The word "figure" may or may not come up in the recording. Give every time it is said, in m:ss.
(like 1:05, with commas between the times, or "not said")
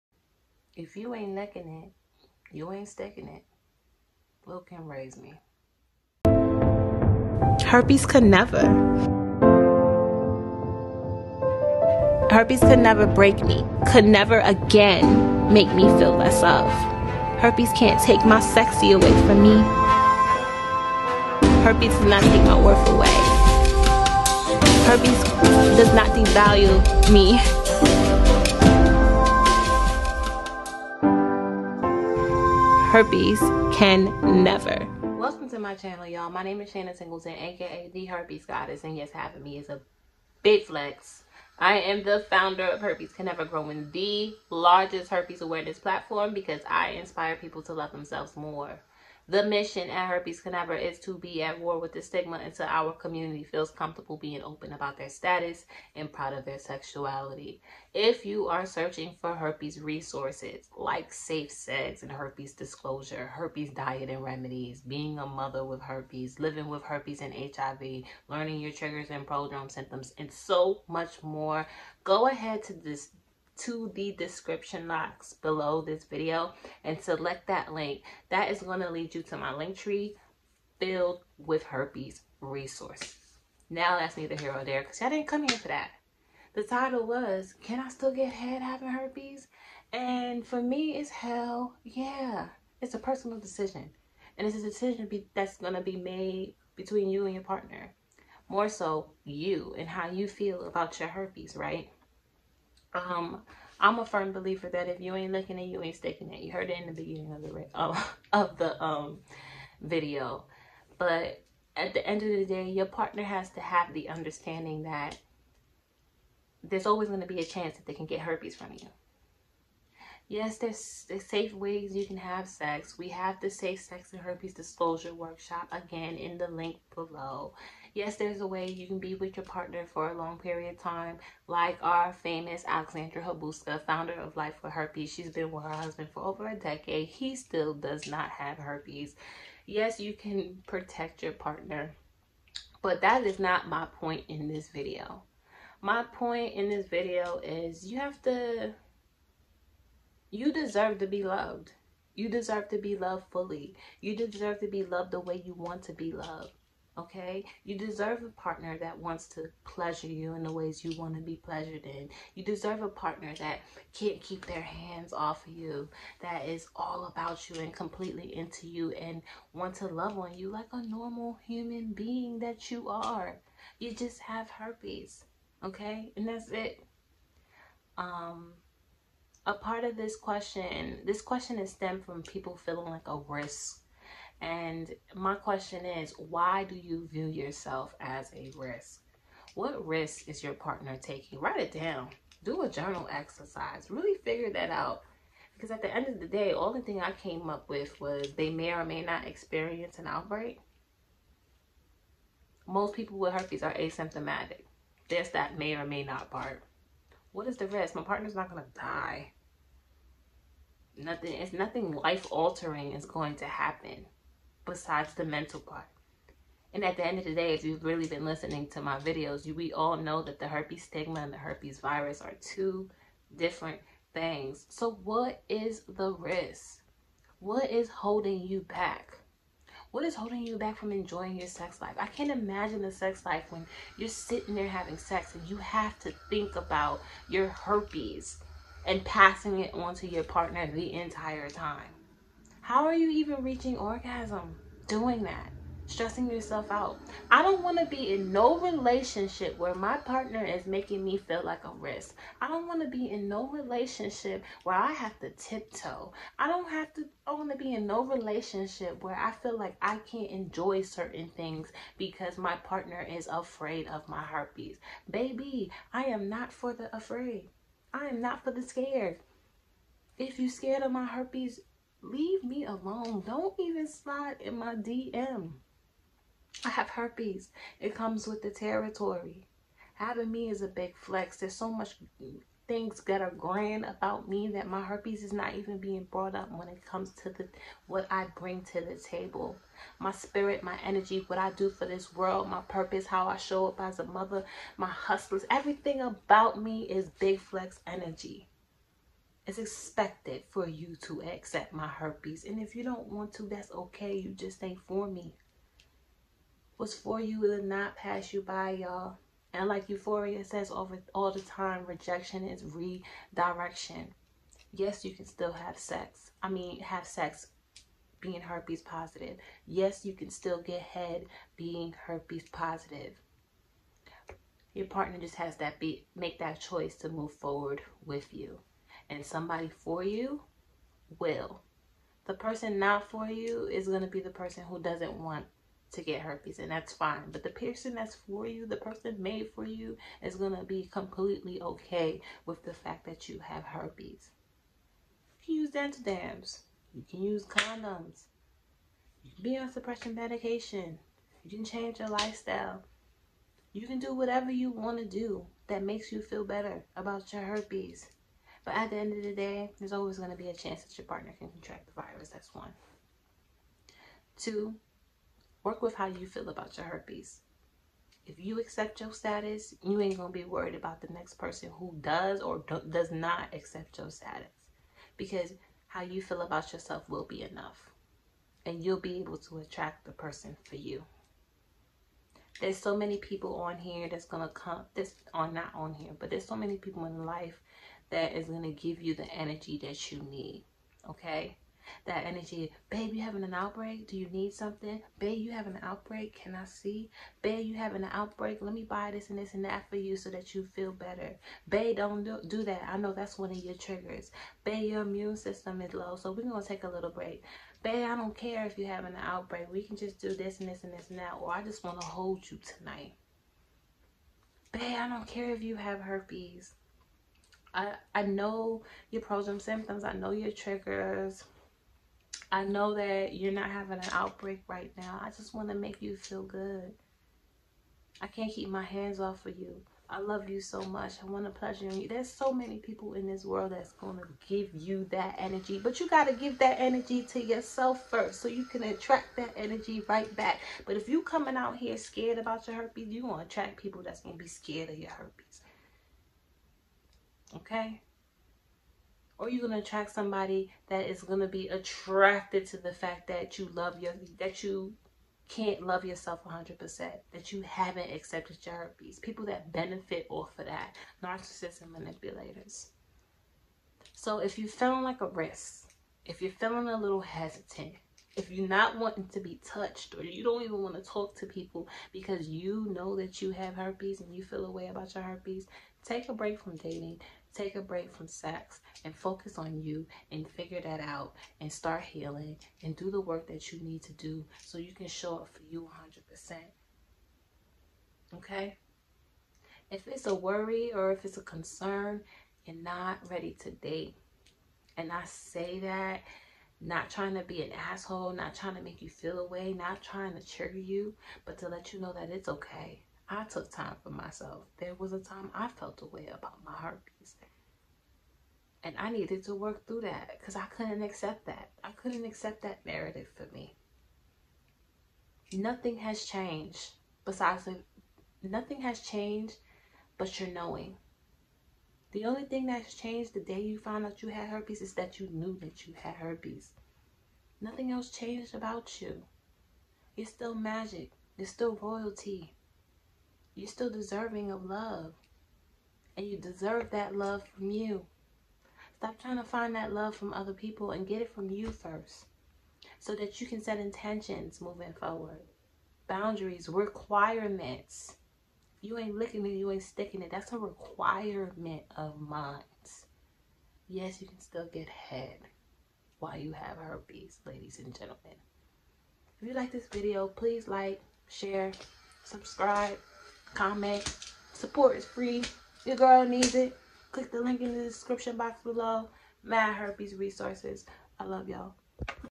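3:14, 8:00.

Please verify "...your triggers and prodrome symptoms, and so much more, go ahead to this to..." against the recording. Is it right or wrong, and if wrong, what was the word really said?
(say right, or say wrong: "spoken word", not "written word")
right.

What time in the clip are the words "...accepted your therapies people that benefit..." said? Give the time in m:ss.
7:38.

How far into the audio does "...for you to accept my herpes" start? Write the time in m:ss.
5:00.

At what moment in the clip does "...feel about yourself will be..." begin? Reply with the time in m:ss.
6:16.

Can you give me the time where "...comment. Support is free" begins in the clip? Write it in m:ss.
9:23.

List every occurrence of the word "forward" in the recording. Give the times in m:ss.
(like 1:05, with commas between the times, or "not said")
5:27, 9:04.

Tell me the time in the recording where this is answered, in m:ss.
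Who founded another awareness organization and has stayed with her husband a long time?
2:12.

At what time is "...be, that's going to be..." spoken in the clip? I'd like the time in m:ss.
1:35.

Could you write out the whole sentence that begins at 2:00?
Yes, there's, there's safe ways you can have sex.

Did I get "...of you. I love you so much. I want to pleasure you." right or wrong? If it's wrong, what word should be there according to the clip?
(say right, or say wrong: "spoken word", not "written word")
right.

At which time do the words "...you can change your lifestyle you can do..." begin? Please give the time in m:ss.
5:51.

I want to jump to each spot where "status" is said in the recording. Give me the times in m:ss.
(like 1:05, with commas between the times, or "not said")
0:55, 6:09, 6:14.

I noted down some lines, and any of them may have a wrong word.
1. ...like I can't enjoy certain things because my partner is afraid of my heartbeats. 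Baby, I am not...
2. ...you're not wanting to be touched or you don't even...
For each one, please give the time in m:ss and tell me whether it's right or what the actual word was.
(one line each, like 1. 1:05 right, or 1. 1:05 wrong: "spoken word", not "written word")
1. 4:19 right
2. 7:48 right.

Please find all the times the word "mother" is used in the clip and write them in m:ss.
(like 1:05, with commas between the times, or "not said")
1:05, 4:54.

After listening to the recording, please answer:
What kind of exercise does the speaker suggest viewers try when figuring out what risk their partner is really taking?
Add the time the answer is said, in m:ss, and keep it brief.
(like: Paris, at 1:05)
journal exercise, at 3:12.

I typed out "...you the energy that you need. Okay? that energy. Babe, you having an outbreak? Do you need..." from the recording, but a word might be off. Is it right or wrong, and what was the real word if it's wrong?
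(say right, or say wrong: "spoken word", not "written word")
right.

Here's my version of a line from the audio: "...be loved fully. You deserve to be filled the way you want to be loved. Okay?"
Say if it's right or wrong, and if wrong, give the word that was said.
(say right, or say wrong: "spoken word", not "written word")
wrong: "loved", not "filled".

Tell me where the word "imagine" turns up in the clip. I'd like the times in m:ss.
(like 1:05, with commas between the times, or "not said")
3:52.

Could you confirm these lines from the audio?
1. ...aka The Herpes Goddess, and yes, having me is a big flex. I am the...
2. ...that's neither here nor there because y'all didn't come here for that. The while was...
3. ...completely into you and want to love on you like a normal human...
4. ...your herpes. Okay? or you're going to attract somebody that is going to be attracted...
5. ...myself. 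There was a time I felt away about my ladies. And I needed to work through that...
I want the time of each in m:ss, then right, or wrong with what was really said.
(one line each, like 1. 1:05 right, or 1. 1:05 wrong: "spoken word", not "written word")
1. 0:37 right
2. 1:23 wrong: "title", not "while"
3. 2:47 right
4. 7:24 right
5. 8:24 wrong: "herpes", not "ladies".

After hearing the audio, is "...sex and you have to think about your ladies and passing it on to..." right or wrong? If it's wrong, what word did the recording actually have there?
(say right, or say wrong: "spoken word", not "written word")
wrong: "herpes", not "ladies".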